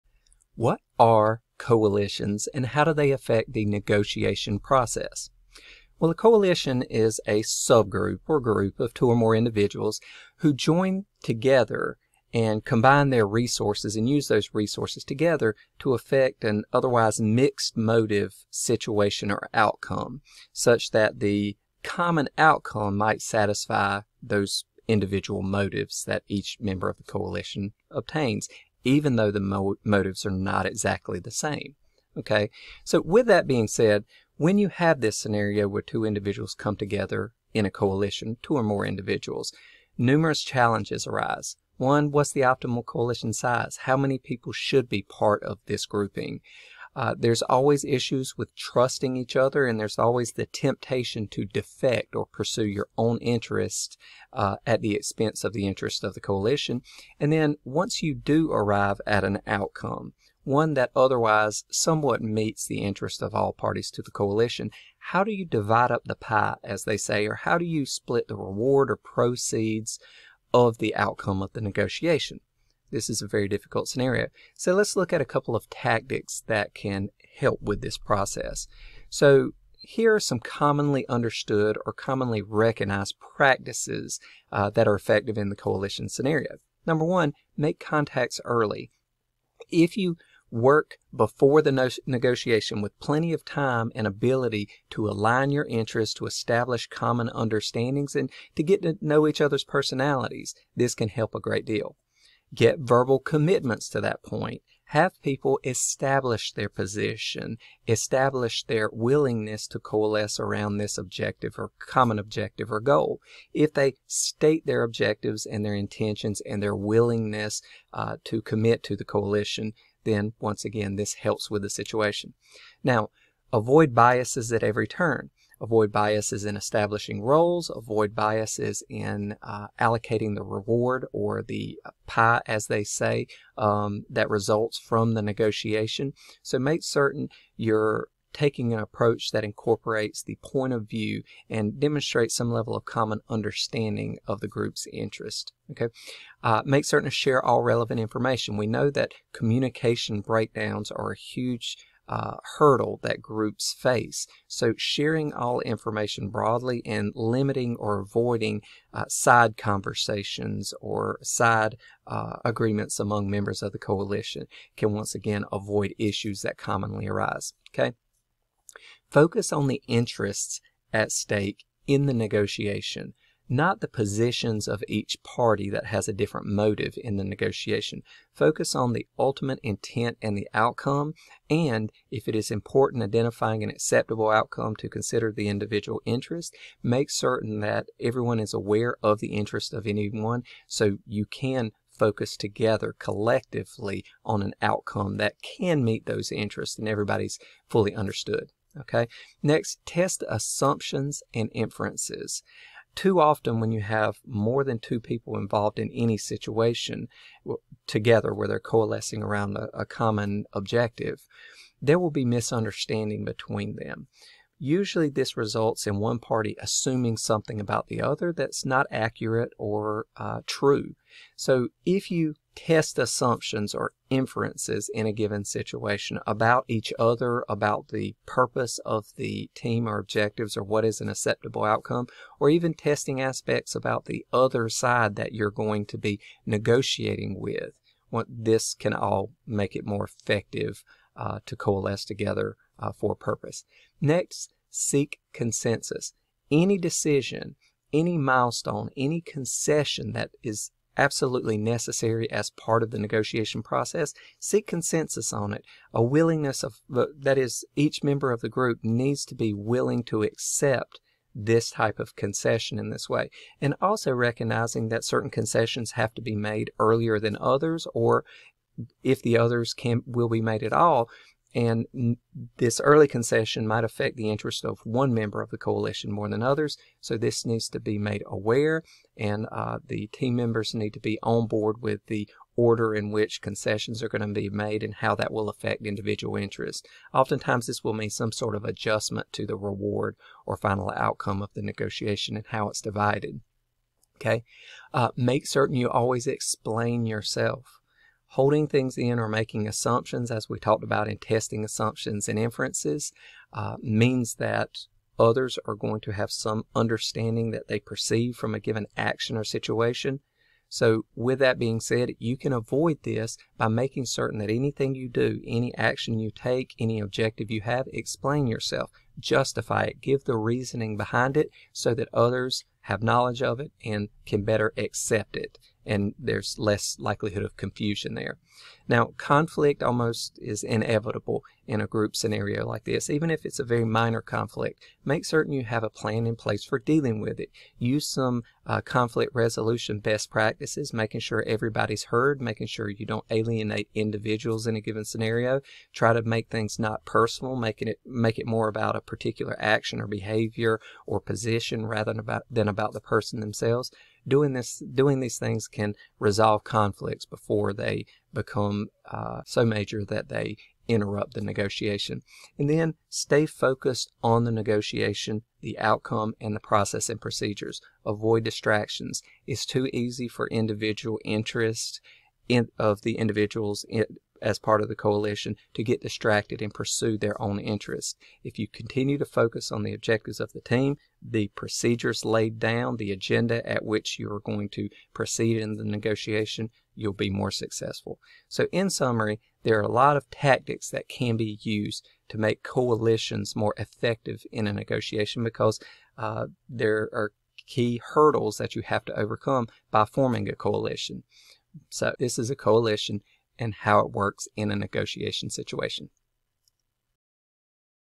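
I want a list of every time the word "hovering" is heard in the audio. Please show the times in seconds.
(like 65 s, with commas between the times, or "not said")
not said.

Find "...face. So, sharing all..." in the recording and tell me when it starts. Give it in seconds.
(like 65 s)
153 s.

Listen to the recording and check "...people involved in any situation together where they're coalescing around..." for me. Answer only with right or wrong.
right.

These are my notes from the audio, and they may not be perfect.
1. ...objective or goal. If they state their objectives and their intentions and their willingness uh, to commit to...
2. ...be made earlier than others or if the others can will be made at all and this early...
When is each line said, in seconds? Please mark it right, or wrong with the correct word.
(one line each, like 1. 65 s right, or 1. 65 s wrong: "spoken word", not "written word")
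1. 112 s right
2. 266 s right.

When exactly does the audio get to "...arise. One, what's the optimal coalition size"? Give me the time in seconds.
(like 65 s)
41 s.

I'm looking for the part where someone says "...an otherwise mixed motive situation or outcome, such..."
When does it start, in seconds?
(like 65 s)
16 s.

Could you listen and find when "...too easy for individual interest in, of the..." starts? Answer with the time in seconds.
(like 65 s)
369 s.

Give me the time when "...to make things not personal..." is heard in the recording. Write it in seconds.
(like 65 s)
346 s.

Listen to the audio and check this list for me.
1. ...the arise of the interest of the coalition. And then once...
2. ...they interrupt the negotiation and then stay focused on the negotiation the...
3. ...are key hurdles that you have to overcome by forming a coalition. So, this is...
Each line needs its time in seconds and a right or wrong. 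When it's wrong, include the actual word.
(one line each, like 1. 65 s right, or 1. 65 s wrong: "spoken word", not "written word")
1. 54 s wrong: "expense", not "arise"
2. 360 s right
3. 397 s right.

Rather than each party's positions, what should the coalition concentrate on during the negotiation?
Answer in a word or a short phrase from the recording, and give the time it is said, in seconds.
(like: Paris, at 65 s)
The interests, at 169 s.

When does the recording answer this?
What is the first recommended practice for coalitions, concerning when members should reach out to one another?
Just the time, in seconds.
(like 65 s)
87 s.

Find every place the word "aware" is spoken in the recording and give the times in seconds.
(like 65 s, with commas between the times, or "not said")
188 s, 278 s.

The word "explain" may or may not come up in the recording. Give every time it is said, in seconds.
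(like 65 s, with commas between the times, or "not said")
296 s, 317 s.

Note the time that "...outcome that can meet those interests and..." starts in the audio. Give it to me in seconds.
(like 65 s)
194 s.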